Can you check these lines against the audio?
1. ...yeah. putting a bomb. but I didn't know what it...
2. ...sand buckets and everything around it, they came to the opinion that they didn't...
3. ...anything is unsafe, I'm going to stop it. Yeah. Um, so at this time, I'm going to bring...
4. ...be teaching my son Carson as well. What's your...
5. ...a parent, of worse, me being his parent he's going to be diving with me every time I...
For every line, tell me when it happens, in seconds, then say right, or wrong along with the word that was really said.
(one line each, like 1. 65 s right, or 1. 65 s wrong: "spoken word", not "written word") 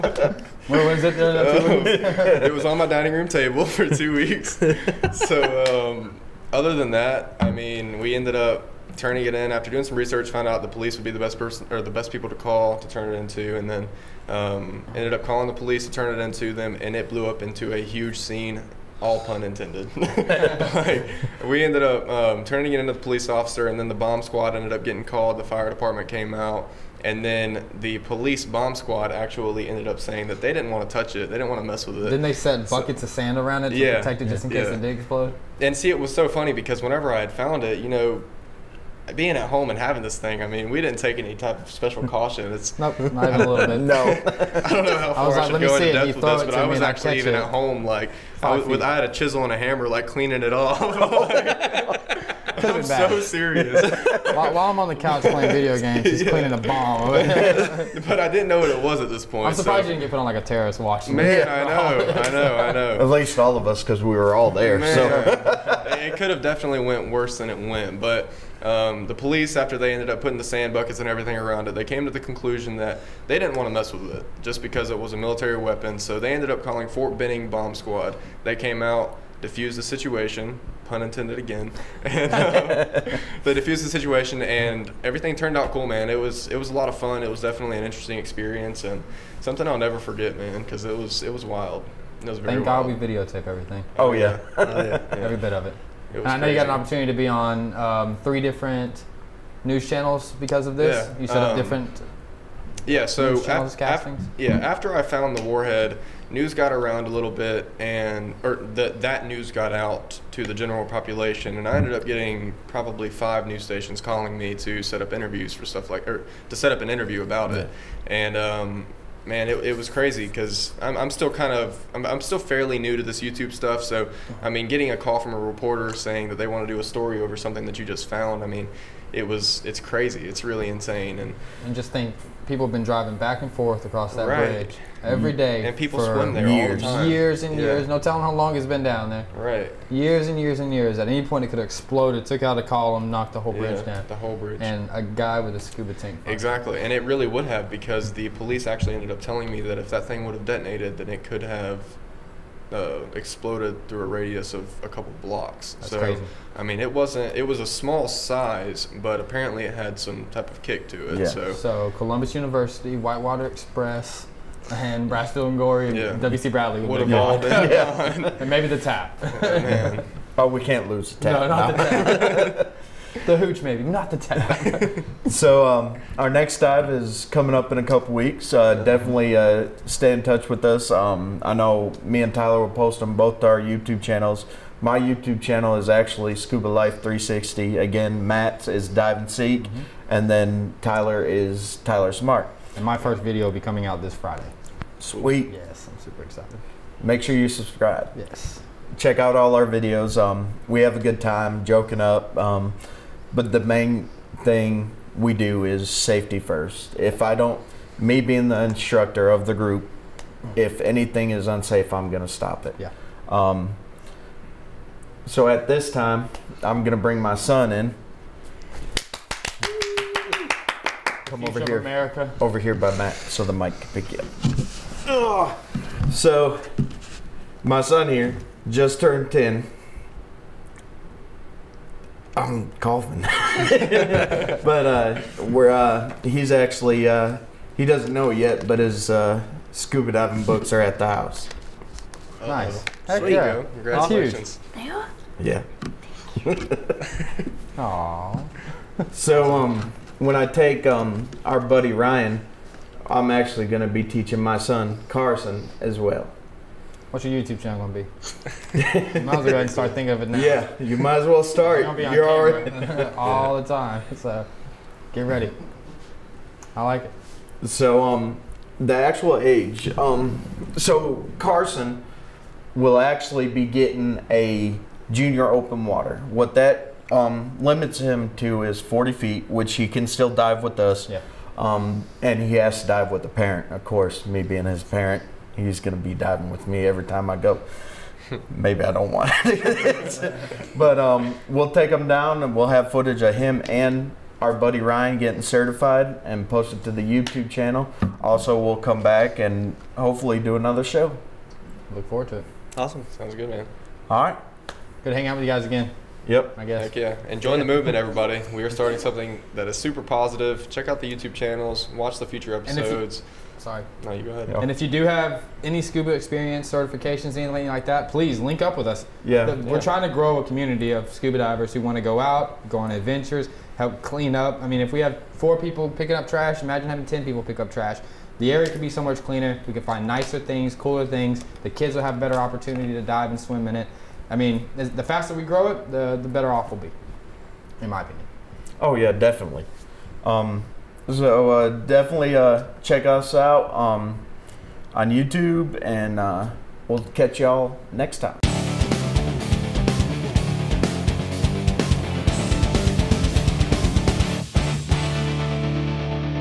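1. 56 s wrong: "cleaning", not "putting"
2. 70 s wrong: "conclusion", not "opinion"
3. 210 s right
4. 253 s right
5. 283 s wrong: "course", not "worse".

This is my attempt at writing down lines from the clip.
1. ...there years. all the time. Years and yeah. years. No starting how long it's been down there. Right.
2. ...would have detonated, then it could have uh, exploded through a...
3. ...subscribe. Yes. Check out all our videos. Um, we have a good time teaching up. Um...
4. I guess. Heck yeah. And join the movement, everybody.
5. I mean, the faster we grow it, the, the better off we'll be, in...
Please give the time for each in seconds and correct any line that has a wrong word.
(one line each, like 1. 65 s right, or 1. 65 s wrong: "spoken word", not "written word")
1. 136 s wrong: "telling", not "starting"
2. 150 s right
3. 197 s wrong: "joking", not "teaching"
4. 306 s right
5. 334 s right.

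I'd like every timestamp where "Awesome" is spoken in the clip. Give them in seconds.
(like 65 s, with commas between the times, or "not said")
244 s, 302 s.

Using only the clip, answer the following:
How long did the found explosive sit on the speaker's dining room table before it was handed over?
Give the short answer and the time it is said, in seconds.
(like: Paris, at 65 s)
2 weeks, at 3 s.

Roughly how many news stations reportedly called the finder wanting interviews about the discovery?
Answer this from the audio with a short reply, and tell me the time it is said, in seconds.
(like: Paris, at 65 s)
5, at 113 s.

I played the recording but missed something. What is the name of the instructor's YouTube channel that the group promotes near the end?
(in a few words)
Scuba Life 360.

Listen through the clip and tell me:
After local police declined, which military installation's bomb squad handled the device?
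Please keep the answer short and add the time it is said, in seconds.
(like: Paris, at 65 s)
Fort Benning, at 76 s.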